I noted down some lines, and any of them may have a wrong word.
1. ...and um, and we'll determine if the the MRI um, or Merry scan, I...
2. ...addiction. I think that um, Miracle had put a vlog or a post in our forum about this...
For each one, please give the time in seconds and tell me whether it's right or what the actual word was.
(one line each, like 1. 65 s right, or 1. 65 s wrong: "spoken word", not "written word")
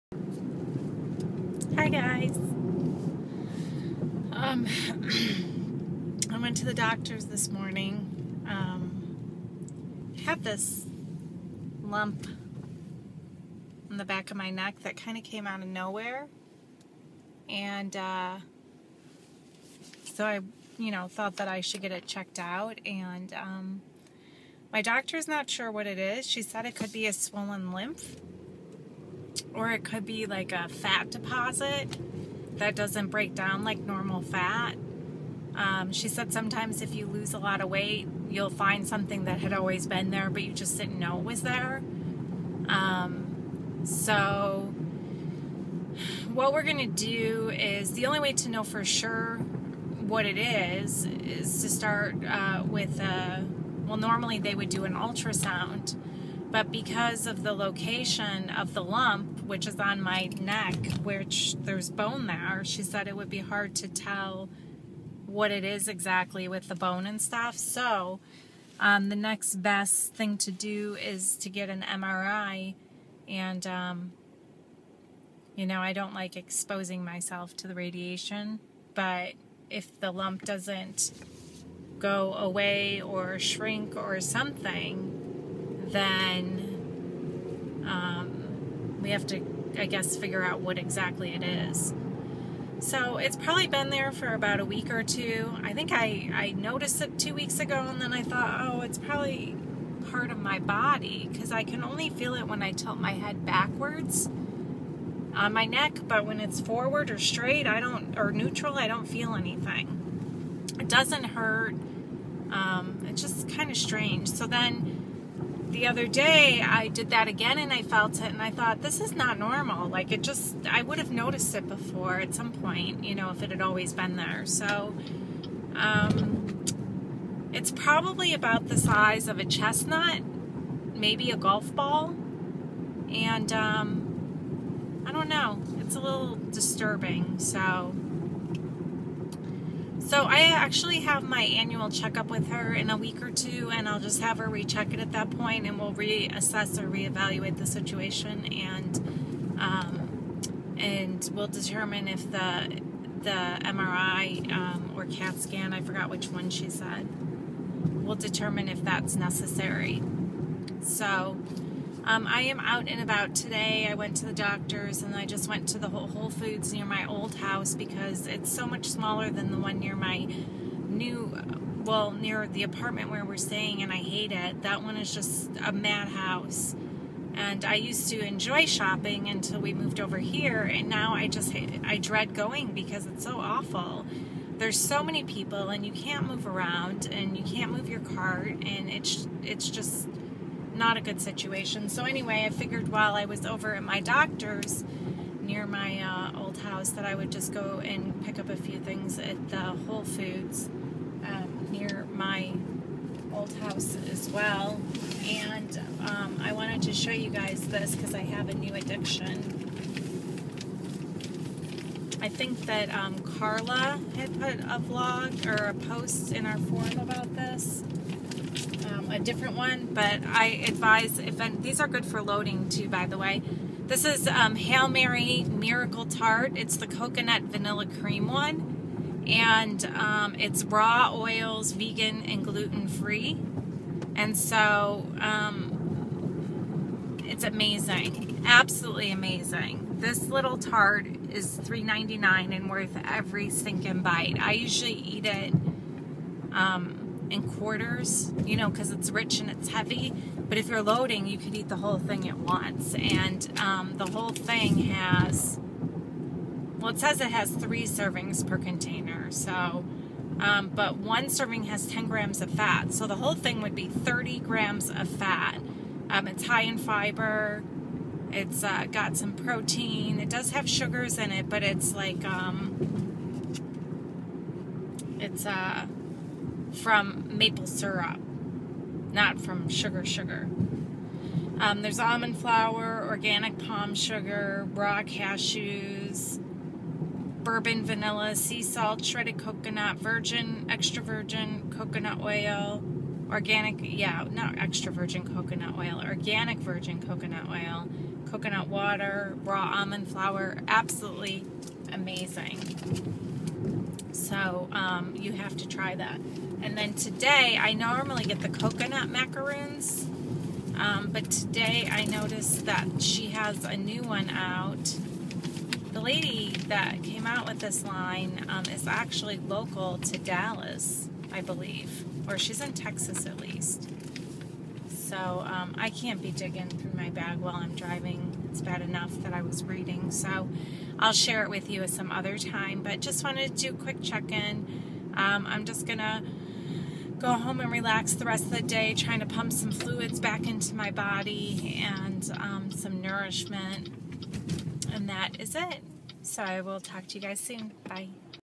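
1. 148 s wrong: "CAT", not "Merry"
2. 208 s wrong: "Carla", not "Miracle".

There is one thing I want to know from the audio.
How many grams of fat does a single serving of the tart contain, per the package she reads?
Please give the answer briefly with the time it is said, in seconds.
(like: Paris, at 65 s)
10 grams, at 261 s.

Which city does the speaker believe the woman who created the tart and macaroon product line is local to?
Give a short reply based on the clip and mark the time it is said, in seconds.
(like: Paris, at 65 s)
Dallas, at 320 s.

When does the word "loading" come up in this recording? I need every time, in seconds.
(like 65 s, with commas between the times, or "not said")
222 s, 250 s.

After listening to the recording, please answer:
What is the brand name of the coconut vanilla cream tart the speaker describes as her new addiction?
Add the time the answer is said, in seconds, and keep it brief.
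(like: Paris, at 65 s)
Hail Merry, at 224 s.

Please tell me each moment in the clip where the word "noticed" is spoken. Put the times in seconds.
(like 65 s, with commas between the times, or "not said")
96 s, 121 s, 312 s.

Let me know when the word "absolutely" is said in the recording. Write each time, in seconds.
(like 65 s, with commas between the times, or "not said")
238 s, 300 s.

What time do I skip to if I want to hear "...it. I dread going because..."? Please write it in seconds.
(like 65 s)
181 s.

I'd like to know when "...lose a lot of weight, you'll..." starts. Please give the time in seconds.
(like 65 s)
37 s.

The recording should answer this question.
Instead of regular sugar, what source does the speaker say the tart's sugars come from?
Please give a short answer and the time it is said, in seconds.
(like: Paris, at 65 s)
maple syrup, at 277 s.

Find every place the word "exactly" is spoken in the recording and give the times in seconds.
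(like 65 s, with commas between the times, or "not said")
65 s, 90 s.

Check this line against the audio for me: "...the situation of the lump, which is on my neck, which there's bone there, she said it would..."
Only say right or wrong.
wrong.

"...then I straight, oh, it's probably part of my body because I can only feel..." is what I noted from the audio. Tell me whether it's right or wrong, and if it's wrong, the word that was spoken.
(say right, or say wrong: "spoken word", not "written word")
wrong: "thought", not "straight".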